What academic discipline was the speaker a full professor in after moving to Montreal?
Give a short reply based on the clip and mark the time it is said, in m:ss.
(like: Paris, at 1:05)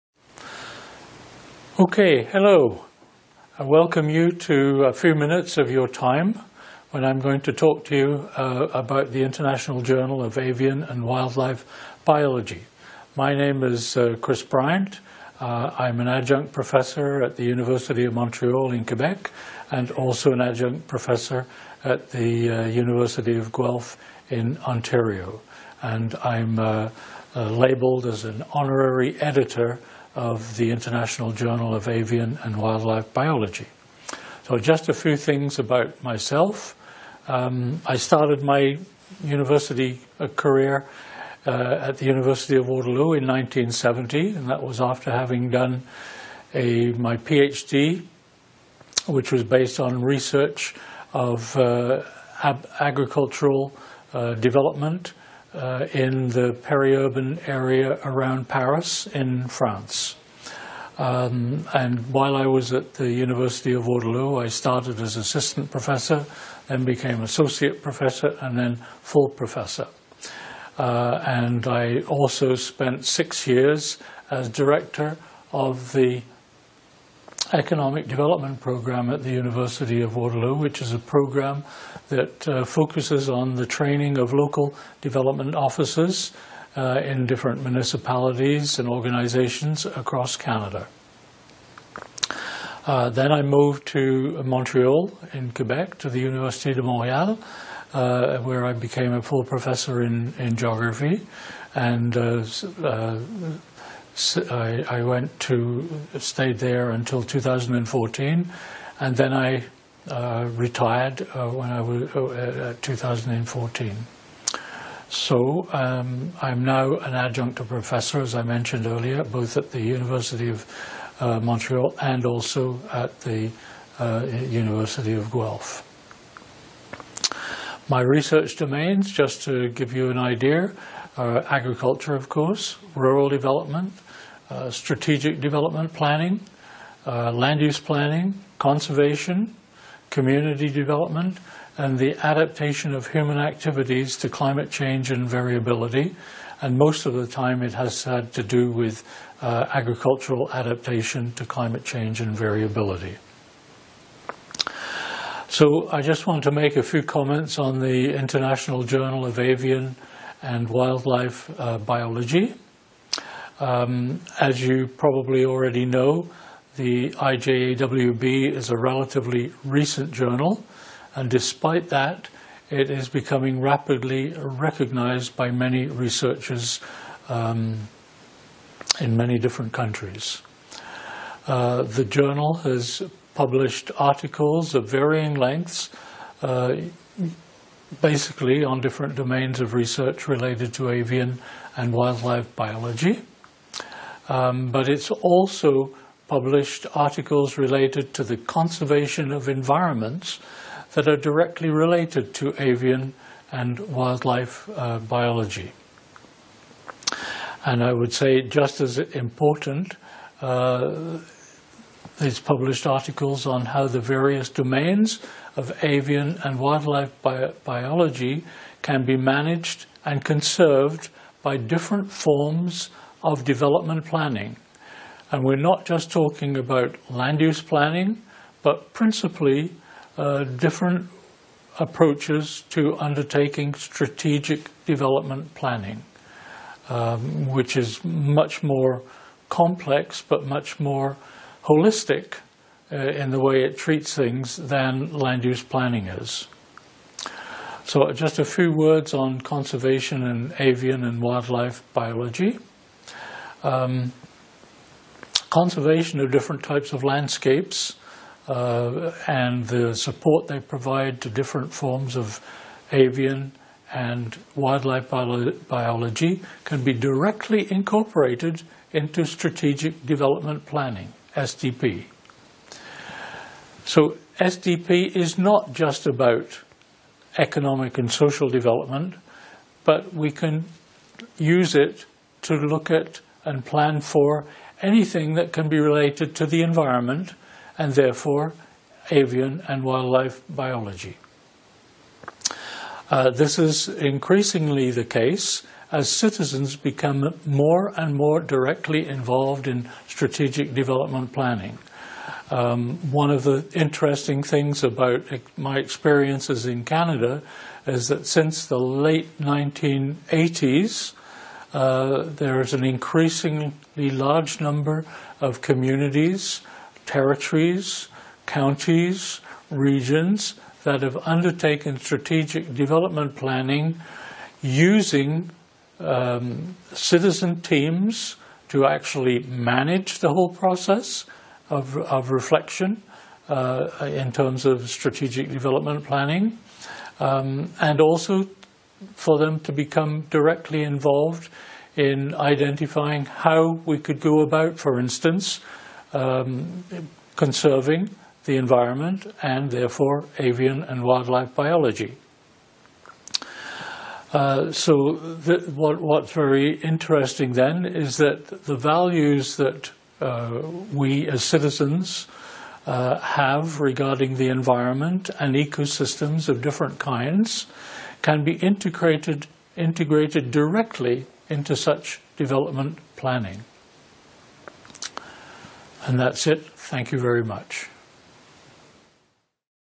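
Geography, at 1:40.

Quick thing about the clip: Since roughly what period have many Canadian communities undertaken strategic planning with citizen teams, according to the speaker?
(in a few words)
Late 1980s.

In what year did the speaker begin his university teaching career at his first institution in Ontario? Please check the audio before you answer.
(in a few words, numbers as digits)
1970.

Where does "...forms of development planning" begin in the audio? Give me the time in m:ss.
3:42.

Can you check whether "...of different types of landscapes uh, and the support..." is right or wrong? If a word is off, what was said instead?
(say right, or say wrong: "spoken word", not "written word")
right.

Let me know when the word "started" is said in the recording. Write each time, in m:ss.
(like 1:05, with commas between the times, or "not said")
0:37, 1:04.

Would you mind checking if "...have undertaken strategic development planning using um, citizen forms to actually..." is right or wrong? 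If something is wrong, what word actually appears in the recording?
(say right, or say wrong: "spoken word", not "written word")
wrong: "teams", not "forms".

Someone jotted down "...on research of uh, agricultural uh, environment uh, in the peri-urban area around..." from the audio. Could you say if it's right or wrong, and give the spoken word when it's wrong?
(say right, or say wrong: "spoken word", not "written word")
wrong: "development", not "environment".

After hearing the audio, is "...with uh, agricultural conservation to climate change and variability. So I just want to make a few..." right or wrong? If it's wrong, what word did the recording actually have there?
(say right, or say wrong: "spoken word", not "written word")
wrong: "adaptation", not "conservation".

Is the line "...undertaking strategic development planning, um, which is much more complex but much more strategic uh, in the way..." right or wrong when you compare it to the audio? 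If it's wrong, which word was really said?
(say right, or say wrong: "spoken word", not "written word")
wrong: "holistic", not "strategic".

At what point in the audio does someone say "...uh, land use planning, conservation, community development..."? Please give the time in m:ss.
2:17.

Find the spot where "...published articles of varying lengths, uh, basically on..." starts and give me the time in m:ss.
3:03.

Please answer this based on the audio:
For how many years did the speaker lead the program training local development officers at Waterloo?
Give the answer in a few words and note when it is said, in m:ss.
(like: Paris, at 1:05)
6, at 1:13.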